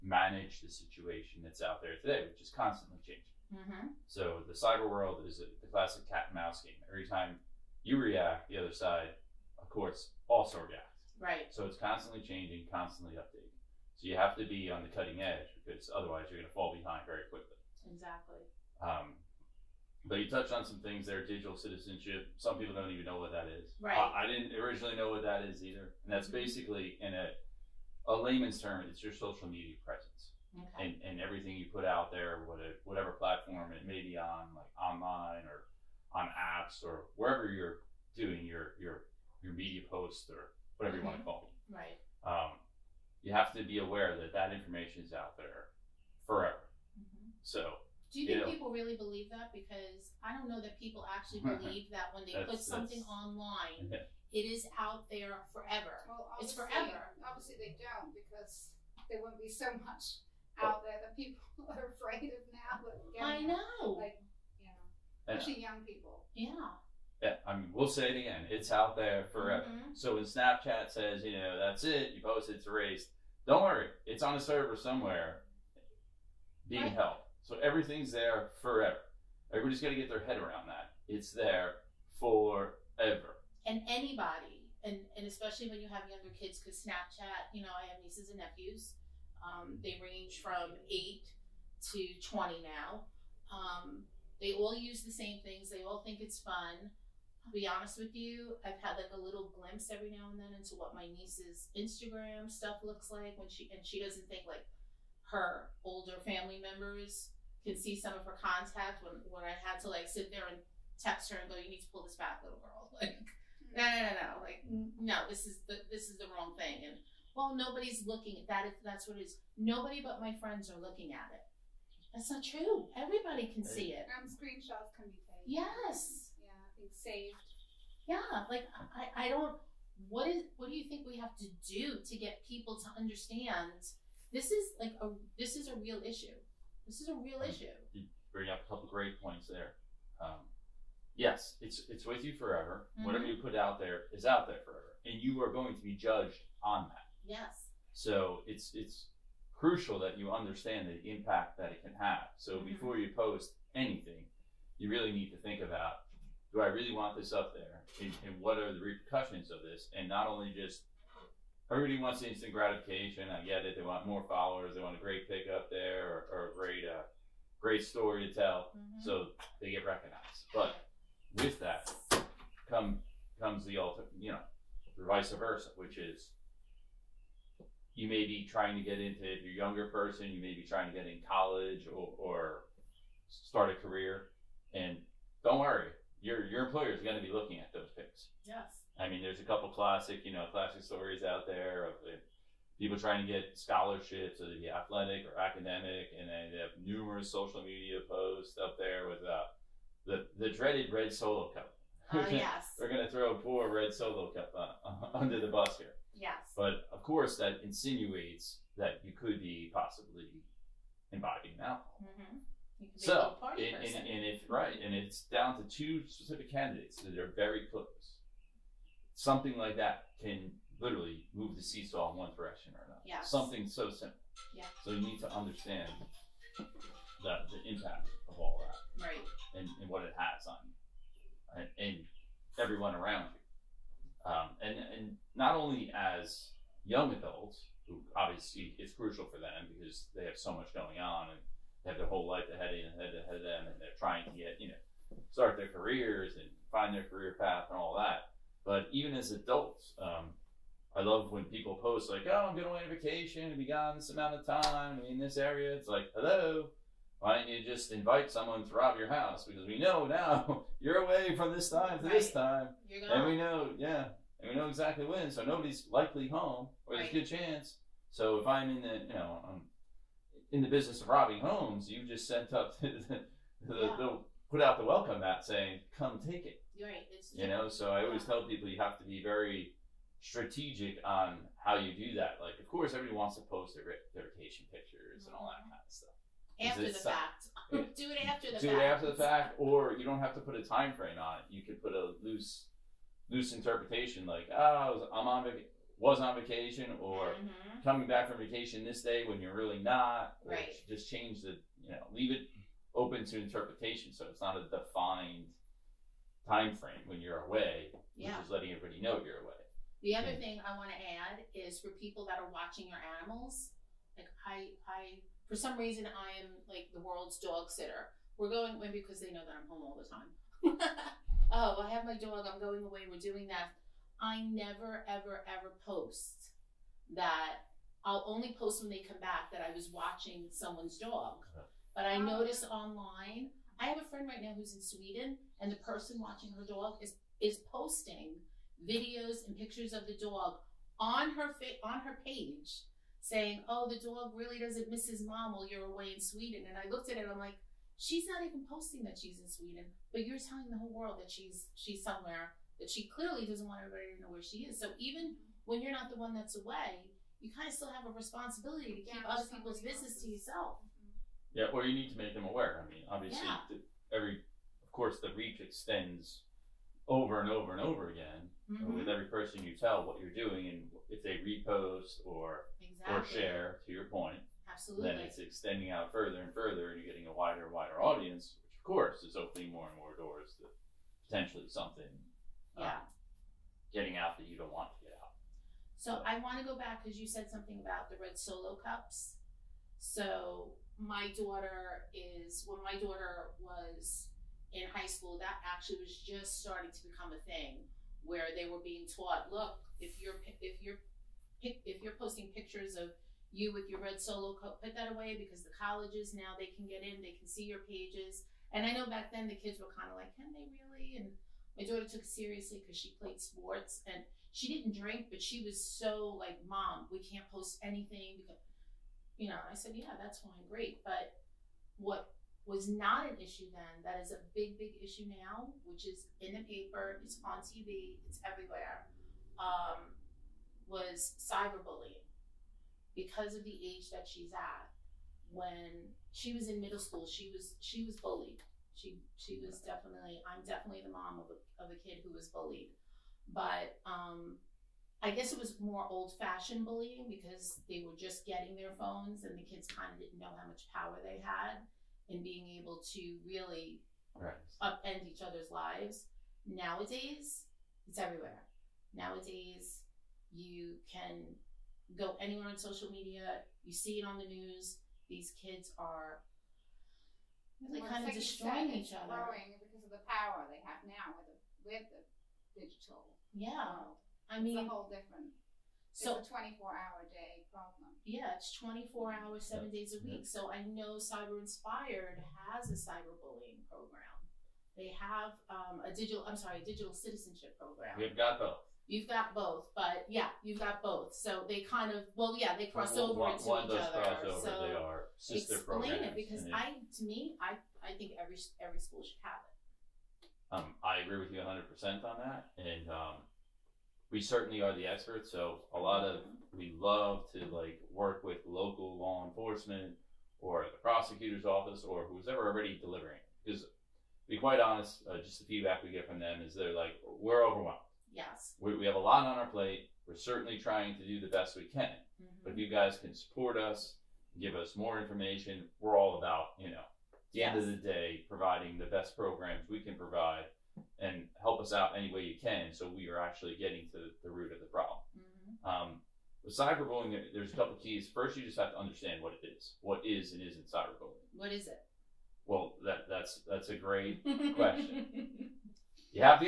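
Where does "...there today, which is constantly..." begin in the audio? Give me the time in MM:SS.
00:01.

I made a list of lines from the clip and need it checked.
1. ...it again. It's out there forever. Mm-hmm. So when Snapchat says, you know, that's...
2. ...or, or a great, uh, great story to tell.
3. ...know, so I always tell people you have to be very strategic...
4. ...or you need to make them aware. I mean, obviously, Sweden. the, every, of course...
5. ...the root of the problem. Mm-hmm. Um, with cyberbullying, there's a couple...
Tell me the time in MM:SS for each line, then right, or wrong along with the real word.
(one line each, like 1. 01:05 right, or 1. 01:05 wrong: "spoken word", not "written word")
1. 01:08 right
2. 02:46 right
3. 04:37 right
4. 06:01 wrong: "Yeah", not "Sweden"
5. 08:54 right.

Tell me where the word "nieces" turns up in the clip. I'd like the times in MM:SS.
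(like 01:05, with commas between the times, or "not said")
01:28, 01:41.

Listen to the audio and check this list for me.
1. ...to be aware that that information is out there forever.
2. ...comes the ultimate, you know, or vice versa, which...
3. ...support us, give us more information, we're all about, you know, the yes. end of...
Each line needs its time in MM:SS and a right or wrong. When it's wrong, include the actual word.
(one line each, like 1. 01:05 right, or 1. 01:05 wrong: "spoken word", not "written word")
1. 00:43 right
2. 02:53 right
3. 08:43 right.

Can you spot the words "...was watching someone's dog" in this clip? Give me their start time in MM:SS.
05:29.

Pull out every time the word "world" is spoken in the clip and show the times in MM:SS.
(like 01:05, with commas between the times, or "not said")
00:04, 05:17, 05:51, 07:54.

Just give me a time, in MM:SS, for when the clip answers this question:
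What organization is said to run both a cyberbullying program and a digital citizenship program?
08:01.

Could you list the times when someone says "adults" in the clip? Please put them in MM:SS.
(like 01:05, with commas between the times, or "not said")
03:57, 04:09.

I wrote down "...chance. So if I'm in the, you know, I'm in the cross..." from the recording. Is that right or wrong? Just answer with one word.
wrong.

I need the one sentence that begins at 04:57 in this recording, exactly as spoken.
coming back from vacation this day when you're really not.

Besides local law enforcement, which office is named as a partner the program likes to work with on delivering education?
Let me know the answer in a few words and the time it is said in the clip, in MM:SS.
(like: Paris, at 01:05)
the prosecutor's office, at 08:31.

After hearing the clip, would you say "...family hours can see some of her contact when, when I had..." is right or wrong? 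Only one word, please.
wrong.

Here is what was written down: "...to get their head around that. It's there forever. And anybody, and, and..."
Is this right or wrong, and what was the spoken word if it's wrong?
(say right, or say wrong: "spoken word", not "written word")
right.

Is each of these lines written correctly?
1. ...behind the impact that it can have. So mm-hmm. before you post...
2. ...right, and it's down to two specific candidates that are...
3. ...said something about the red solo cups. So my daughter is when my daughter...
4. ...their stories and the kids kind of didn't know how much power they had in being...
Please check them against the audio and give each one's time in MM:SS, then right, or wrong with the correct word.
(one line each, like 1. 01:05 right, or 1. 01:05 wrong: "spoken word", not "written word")
1. 02:30 wrong: "understand", not "behind"
2. 03:34 right
3. 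06:27 right
4. 07:28 wrong: "phones", not "stories".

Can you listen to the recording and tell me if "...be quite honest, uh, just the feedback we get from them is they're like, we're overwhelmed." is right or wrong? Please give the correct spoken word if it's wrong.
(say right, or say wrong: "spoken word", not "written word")
right.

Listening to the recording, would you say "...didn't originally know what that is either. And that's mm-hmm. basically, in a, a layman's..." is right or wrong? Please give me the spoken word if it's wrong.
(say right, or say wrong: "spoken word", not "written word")
right.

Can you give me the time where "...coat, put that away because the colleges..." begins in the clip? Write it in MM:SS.
06:44.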